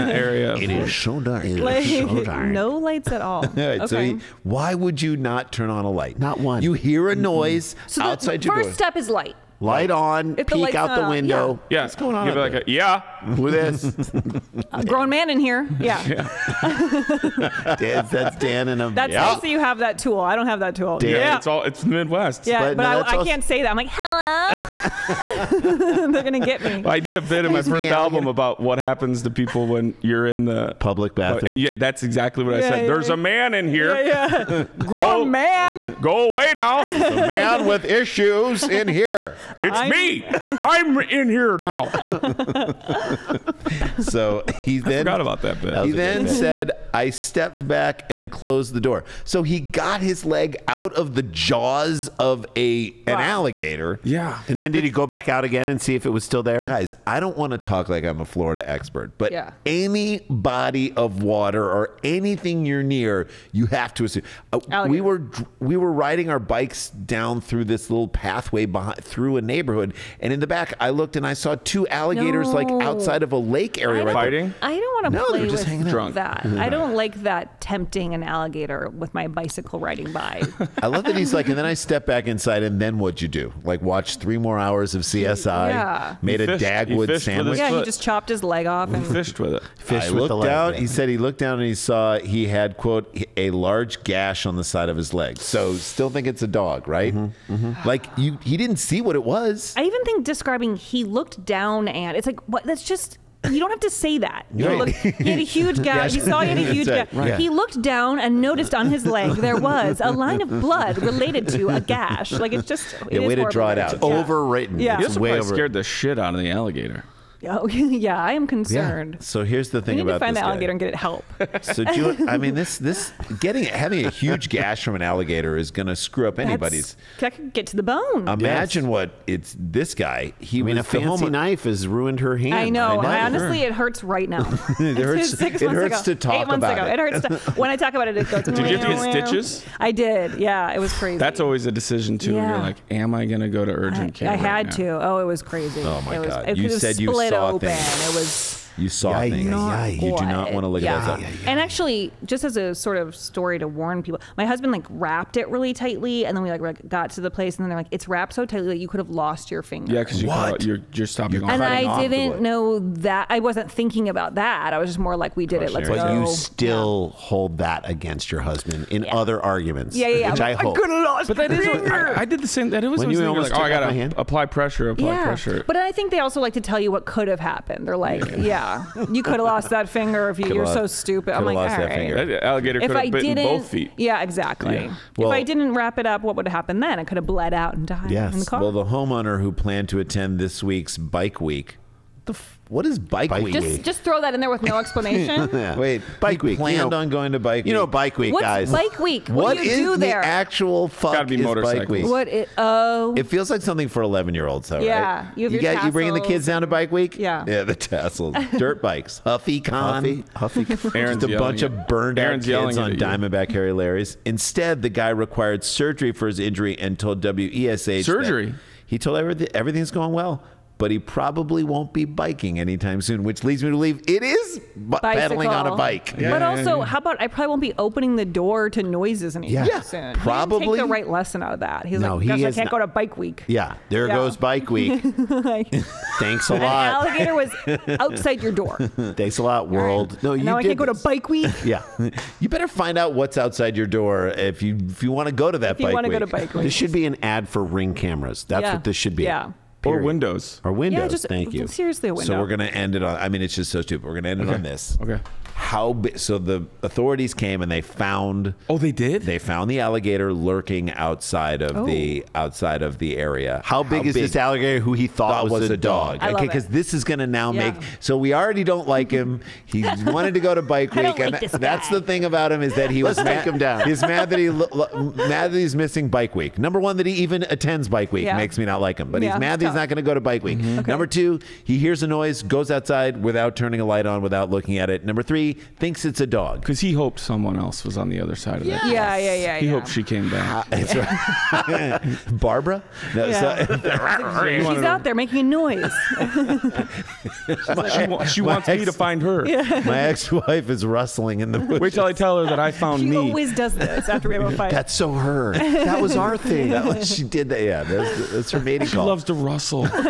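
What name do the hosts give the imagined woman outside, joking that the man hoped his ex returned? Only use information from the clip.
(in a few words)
Barbara.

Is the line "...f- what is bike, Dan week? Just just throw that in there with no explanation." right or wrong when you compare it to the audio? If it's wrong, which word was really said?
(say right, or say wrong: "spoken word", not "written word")
wrong: "Bike", not "Dan".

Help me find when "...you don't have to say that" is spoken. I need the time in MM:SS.
01:43.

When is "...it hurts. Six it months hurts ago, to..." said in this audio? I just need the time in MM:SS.
02:14.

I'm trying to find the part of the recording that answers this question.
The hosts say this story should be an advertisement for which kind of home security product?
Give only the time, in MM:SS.
04:07.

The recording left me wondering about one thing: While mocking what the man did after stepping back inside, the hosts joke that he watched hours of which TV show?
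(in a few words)
CSI.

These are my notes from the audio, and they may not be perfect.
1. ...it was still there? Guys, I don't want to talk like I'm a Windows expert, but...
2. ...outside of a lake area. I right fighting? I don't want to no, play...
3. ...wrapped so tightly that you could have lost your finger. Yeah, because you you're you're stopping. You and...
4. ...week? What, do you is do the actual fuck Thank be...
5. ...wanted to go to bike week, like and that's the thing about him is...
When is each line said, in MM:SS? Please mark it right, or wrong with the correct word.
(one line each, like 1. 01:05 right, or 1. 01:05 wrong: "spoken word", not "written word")
1. 00:56 wrong: "Florida", not "Windows"
2. 01:12 right
3. 02:38 right
4. 03:18 wrong: "Gotta", not "Thank"
5. 04:30 right.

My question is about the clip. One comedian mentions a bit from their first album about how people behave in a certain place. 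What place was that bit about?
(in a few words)
Public bathroom.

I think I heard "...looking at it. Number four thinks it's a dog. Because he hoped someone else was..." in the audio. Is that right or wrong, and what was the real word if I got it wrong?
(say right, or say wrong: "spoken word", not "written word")
wrong: "three", not "four".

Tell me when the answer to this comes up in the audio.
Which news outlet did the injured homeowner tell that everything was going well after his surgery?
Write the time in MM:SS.
03:37.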